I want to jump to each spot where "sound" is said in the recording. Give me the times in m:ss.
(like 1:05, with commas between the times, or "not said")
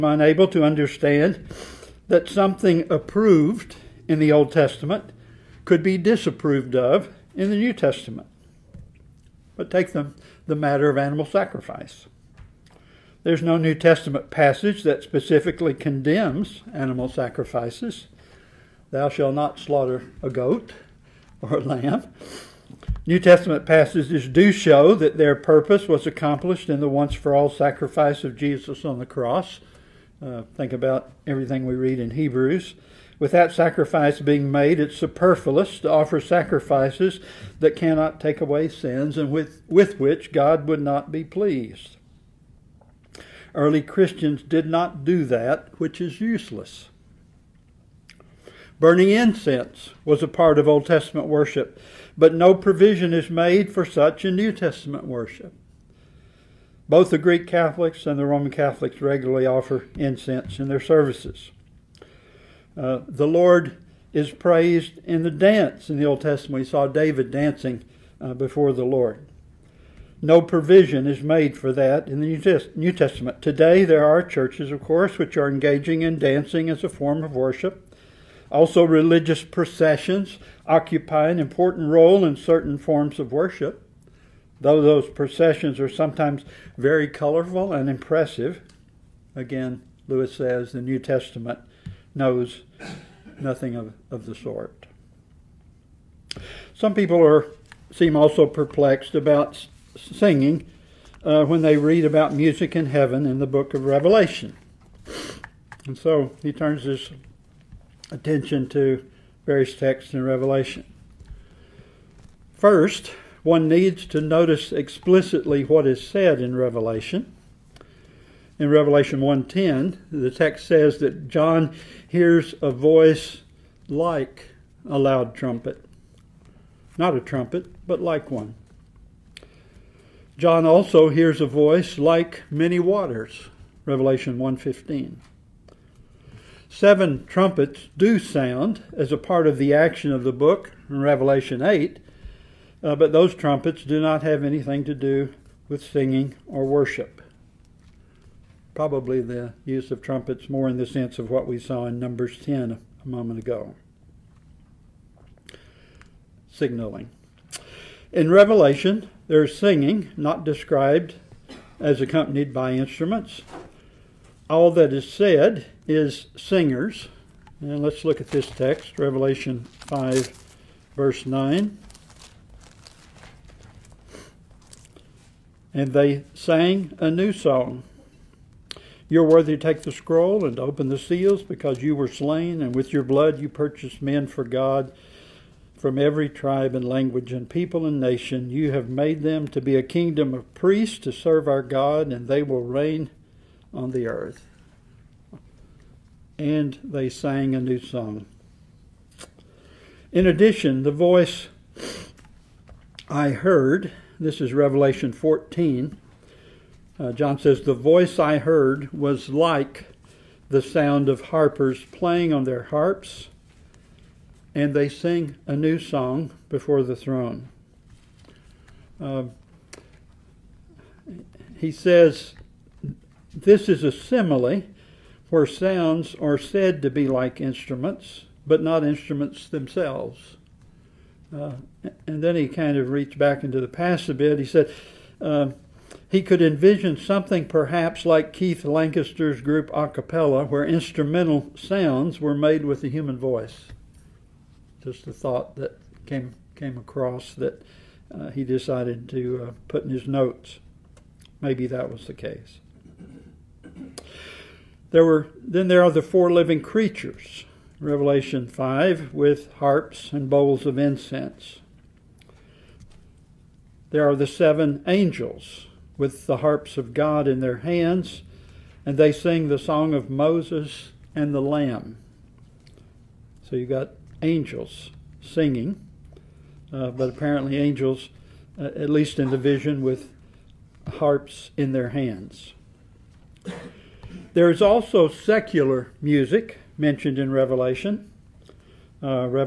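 2:18, 3:30, 3:45, 4:01.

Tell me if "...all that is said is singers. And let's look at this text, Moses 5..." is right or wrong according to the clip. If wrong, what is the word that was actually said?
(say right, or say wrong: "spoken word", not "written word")
wrong: "Revelation", not "Moses".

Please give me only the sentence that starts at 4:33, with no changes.
So you've got angels singing, uh, but apparently angels, uh, at least in the vision, with harps in their hands.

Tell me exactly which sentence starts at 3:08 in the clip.
You have made them to be a kingdom of priests to serve our God, and they will reign on the earth.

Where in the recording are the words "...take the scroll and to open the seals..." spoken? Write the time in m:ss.
2:59.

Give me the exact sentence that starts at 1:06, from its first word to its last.
We saw David dancing uh, before the Lord.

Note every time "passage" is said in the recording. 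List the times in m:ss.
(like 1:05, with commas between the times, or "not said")
0:14, 0:23.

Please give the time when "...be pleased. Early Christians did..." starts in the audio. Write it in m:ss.
0:41.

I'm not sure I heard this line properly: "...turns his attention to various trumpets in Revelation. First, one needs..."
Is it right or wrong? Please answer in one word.
wrong.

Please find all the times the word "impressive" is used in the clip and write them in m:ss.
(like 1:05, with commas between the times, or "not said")
1:27.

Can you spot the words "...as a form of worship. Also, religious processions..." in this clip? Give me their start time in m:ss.
1:16.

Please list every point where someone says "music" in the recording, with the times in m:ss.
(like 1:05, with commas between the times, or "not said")
1:42, 4:46.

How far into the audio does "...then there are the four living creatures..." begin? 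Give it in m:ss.
4:15.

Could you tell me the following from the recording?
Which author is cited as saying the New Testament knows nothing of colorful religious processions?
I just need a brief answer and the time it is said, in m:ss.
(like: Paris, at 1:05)
Lewis, at 1:30.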